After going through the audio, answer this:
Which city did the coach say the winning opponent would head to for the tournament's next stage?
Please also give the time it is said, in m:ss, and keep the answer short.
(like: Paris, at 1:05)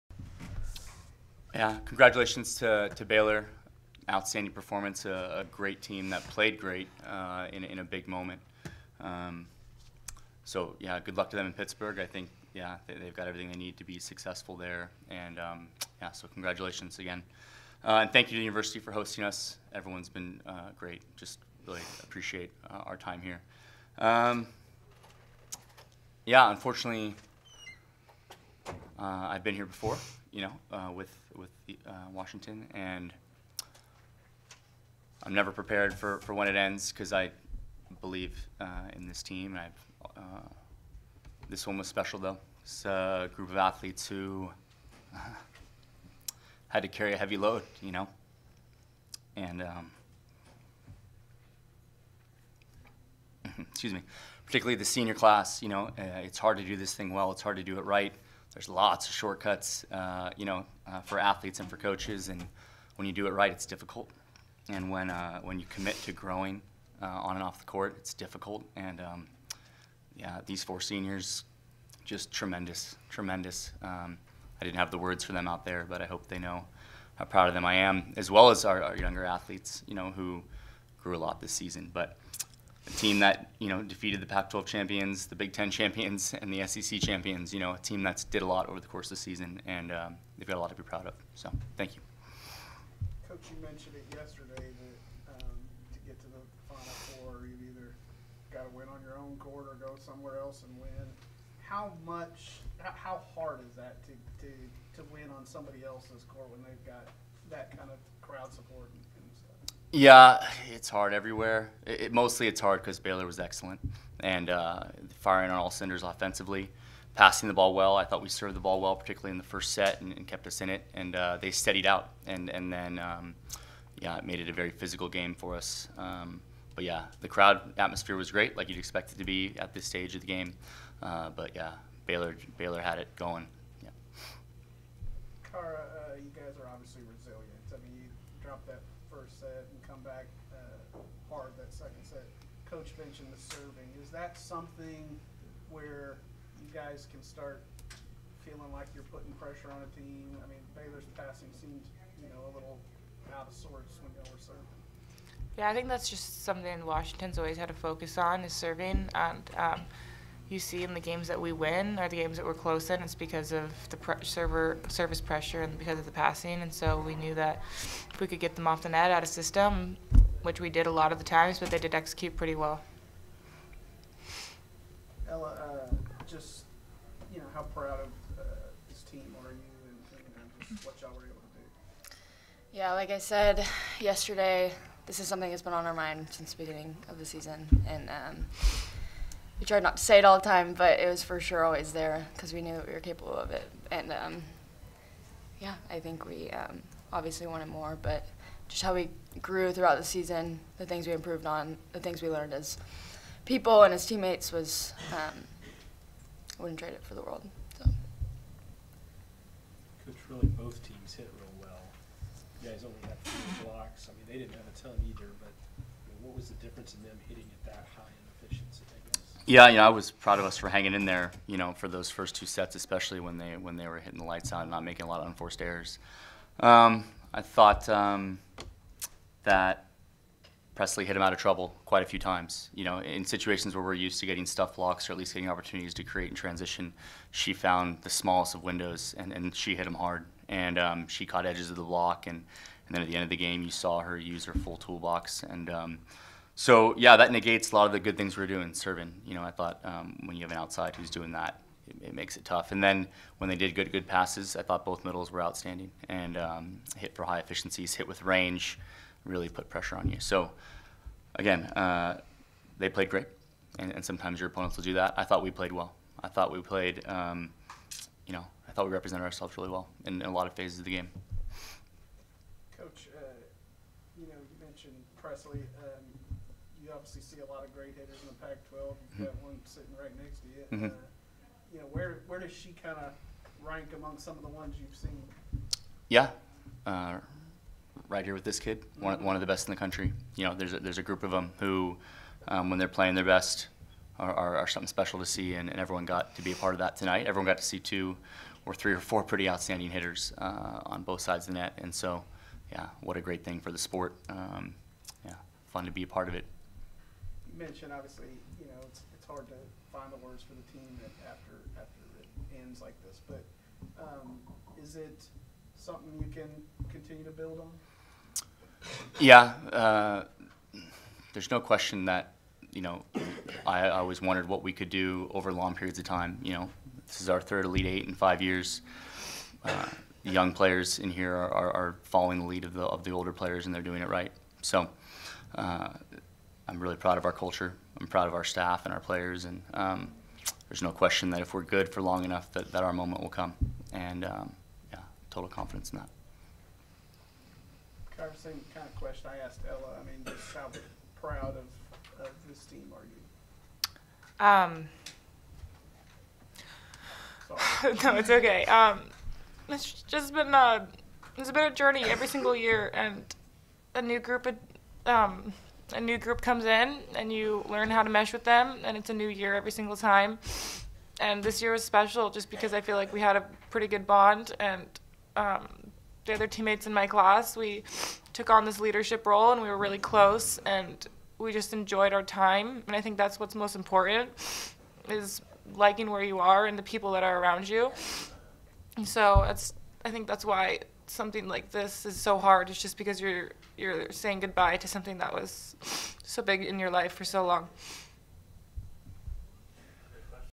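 Pittsburgh, at 0:11.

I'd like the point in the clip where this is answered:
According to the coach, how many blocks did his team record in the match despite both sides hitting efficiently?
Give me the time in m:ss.
3:33.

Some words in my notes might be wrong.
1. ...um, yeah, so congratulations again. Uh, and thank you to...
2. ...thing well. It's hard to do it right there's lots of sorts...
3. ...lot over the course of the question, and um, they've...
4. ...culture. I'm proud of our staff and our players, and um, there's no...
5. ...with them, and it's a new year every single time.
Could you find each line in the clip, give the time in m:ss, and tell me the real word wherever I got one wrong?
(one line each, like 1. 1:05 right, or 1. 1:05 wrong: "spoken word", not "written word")
1. 0:15 right
2. 0:56 wrong: "shortcuts", not "sorts"
3. 1:28 wrong: "season", not "question"
4. 5:37 right
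5. 6:08 right.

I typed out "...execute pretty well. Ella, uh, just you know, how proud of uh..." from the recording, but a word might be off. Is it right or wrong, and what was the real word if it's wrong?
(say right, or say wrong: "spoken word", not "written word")
right.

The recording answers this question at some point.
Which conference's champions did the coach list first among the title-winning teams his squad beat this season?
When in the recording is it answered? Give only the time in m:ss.
1:24.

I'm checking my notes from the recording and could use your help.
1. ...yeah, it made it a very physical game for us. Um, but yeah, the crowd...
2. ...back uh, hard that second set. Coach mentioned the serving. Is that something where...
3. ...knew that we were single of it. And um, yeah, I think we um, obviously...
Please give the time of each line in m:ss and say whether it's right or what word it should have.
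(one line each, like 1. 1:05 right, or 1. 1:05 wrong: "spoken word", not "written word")
1. 2:03 right
2. 2:20 right
3. 3:12 wrong: "capable", not "single".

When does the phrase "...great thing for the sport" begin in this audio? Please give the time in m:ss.
5:03.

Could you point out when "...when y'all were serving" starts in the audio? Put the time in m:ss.
2:34.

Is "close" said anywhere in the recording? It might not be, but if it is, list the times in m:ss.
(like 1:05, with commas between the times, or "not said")
2:42, 6:19.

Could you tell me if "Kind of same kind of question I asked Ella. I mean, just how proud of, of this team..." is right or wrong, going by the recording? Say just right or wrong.
right.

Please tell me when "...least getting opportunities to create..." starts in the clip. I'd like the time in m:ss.
3:55.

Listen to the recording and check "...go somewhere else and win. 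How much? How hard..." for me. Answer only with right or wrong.
right.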